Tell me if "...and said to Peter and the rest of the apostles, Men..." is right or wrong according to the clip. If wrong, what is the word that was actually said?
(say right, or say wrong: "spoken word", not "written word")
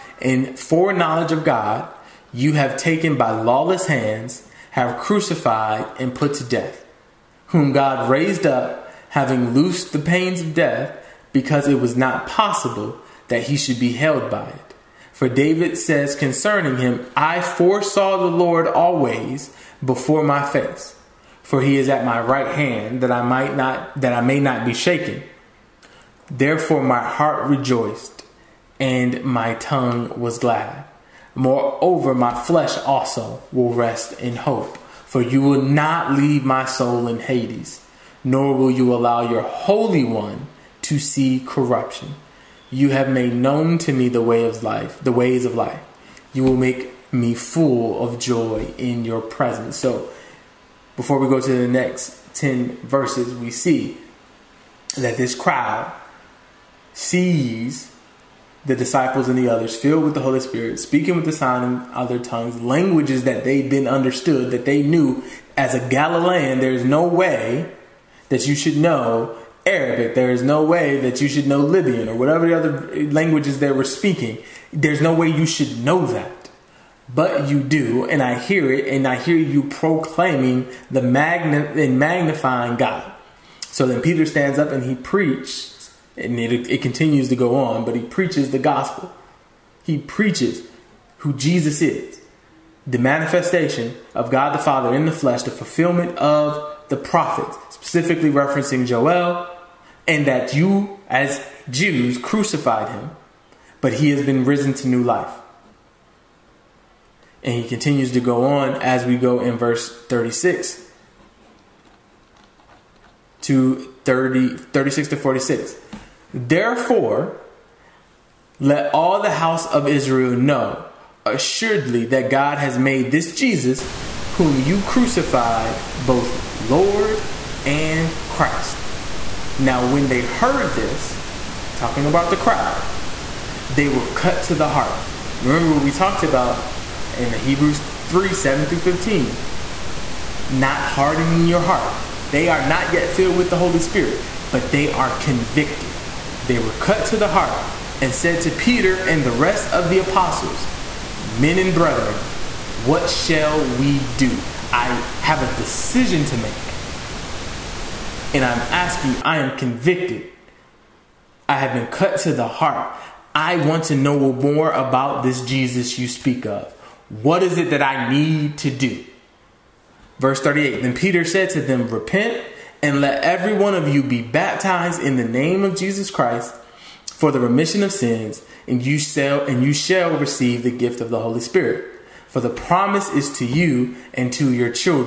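right.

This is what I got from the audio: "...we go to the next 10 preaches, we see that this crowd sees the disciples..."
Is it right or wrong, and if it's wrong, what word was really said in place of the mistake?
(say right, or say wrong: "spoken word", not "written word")
wrong: "verses", not "preaches".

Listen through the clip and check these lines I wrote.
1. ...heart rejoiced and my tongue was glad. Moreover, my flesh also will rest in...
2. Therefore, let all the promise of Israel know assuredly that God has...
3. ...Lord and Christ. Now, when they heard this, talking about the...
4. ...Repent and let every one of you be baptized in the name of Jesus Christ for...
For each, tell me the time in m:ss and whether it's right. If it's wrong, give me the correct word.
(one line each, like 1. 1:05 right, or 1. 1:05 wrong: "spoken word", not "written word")
1. 0:27 right
2. 1:56 wrong: "house", not "promise"
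3. 2:06 right
4. 2:51 right.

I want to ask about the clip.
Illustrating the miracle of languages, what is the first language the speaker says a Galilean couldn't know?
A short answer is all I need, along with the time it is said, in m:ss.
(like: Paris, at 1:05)
Arabic, at 1:09.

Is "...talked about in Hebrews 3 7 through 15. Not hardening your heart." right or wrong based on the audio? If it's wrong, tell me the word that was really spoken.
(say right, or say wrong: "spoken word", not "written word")
right.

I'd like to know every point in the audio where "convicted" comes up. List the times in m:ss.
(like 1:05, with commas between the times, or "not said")
2:25, 2:39.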